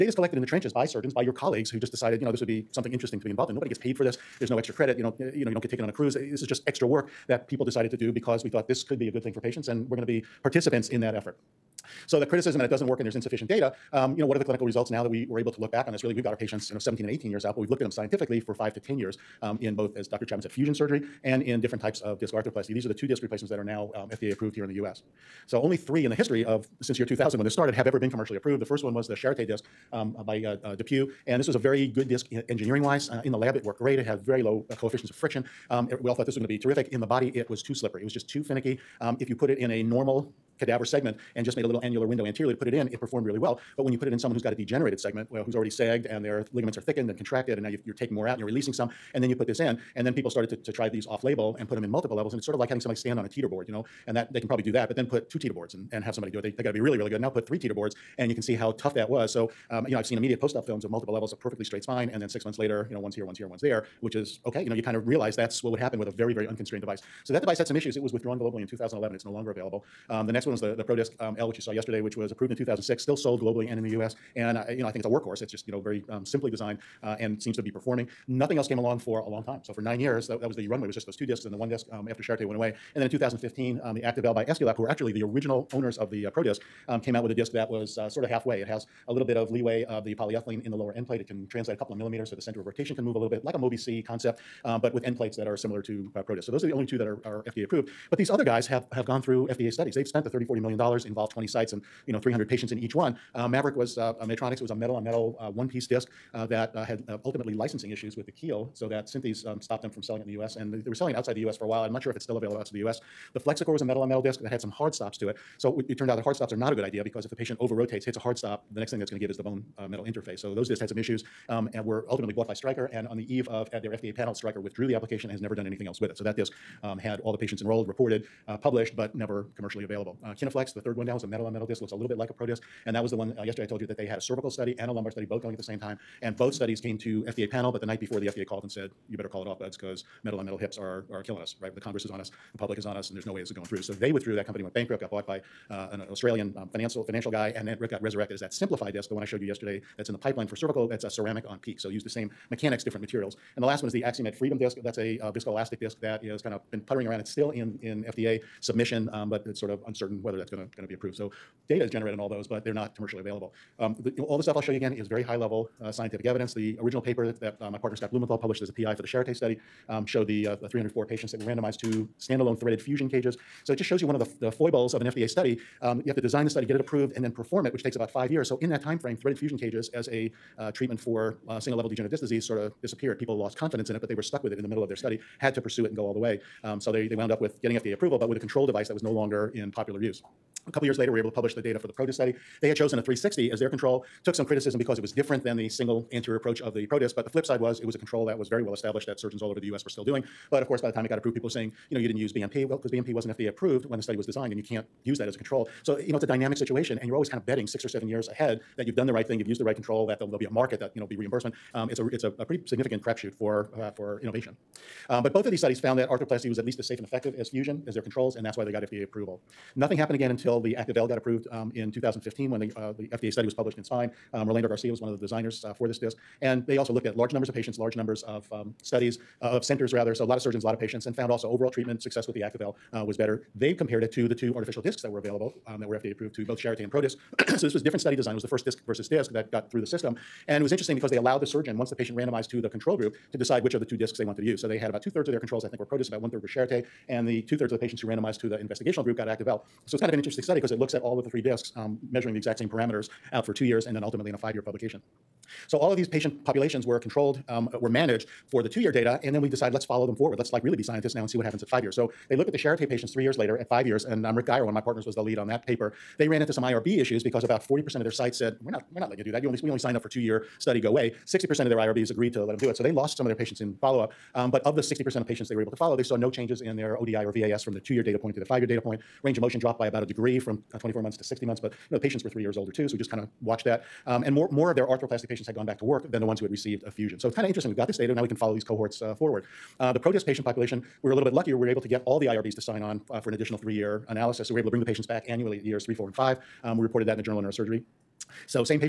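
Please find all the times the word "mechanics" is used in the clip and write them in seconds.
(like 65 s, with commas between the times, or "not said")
152 s.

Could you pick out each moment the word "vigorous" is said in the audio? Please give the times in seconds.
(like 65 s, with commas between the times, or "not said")
not said.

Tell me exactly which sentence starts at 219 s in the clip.
Nothing happened again until the activL got approved um, in 2015 when the, uh, the FDA study was published in Spine.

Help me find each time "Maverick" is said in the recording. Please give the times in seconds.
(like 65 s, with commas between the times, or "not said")
103 s.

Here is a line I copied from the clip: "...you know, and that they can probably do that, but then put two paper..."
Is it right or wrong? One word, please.
wrong.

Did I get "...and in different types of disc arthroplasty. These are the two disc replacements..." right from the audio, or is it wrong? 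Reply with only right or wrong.
right.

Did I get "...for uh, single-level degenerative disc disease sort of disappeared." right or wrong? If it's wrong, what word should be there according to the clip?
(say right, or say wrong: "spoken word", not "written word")
right.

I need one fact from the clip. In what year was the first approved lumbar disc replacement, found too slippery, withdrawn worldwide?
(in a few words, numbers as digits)
2011.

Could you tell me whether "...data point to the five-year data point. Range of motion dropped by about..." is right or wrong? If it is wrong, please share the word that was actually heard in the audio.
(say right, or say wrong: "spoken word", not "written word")
right.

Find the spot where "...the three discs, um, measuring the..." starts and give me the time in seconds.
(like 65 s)
251 s.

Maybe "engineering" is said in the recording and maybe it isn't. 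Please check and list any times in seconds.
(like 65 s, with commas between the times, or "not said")
32 s.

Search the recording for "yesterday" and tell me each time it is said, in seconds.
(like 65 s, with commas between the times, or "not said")
71 s, 133 s, 149 s.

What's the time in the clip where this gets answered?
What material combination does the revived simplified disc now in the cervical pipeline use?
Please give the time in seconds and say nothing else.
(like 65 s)
151 s.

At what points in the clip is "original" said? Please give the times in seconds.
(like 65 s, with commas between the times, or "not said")
85 s, 166 s.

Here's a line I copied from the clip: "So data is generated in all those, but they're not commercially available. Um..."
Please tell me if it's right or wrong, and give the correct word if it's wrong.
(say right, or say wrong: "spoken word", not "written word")
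right.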